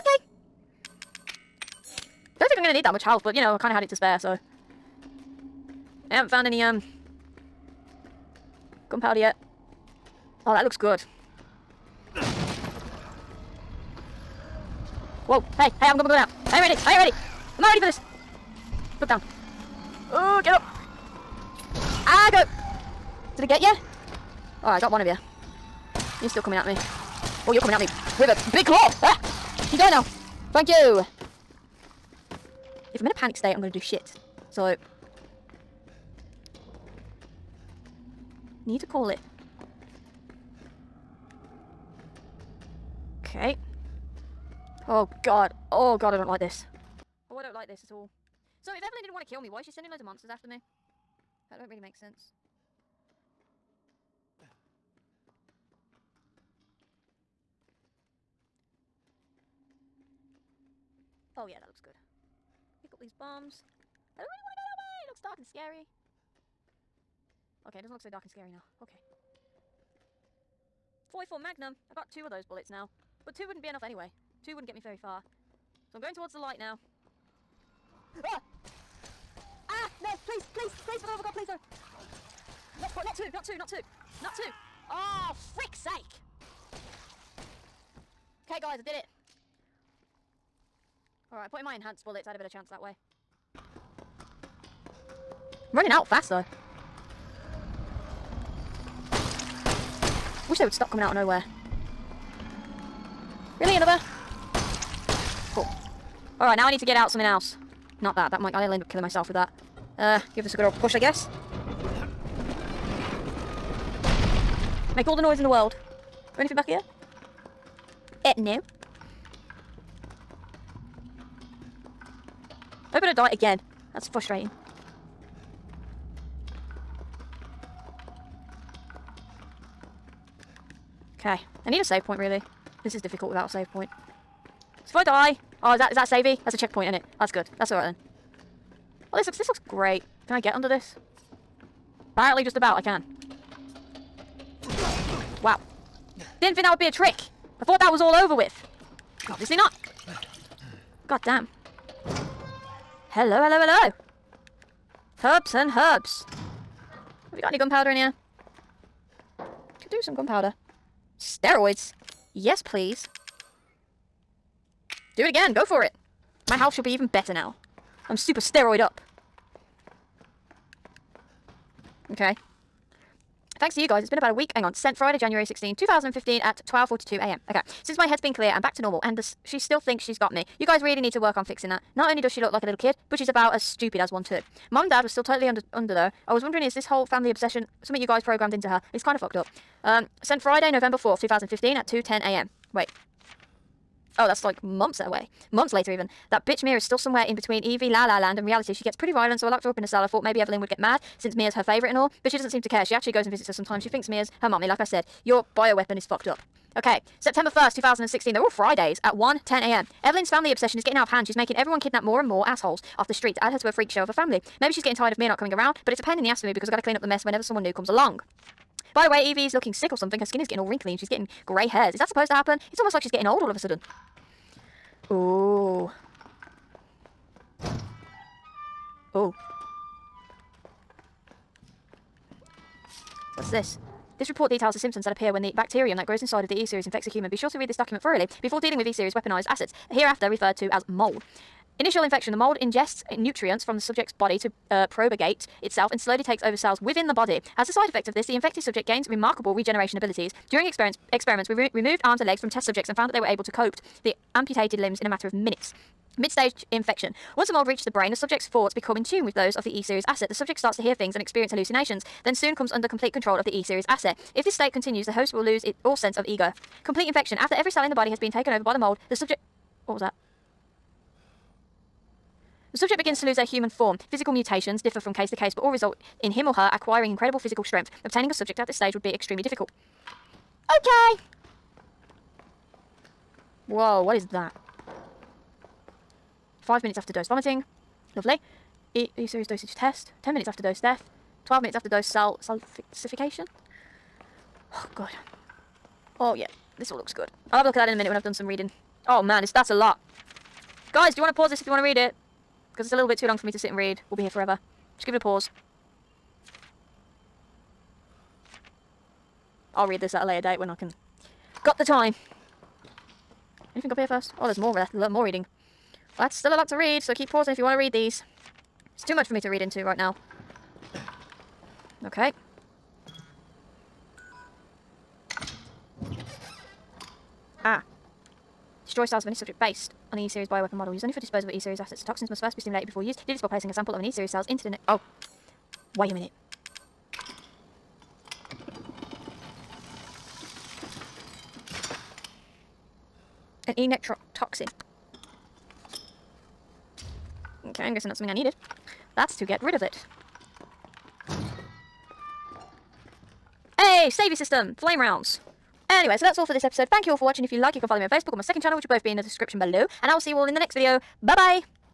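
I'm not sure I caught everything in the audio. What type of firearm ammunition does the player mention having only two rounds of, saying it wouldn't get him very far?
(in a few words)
.44 Magnum.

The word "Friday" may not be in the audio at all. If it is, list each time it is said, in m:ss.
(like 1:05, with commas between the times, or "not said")
2:54, 3:10, 3:28.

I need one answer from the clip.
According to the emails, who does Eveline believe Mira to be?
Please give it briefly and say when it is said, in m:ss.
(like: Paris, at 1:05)
Her mummy, at 3:24.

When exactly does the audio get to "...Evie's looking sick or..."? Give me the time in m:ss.
3:39.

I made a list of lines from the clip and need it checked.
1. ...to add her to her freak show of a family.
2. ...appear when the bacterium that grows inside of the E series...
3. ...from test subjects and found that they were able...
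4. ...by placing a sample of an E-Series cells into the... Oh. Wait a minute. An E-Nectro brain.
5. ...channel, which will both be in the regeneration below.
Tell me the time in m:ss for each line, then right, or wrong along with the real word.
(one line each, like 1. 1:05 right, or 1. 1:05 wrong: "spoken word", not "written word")
1. 3:33 right
2. 3:55 right
3. 4:12 right
4. 5:33 wrong: "toxin", not "brain"
5. 5:58 wrong: "description", not "regeneration".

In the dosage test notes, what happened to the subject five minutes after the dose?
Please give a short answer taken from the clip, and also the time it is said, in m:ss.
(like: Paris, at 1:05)
Vomiting, at 4:47.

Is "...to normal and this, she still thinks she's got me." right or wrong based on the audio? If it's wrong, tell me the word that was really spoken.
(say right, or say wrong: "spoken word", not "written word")
right.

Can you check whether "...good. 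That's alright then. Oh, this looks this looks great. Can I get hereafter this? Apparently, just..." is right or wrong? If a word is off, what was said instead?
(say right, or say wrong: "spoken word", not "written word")
wrong: "under", not "hereafter".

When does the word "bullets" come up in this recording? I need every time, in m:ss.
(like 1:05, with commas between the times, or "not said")
1:12, 1:32.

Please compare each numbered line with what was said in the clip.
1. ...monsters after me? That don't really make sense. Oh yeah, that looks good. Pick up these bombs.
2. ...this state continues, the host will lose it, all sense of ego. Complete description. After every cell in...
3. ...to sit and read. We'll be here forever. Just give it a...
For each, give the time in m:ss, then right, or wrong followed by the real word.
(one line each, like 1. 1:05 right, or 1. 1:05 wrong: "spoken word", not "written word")
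1. 0:50 right
2. 4:24 wrong: "infection", not "description"
3. 5:03 right.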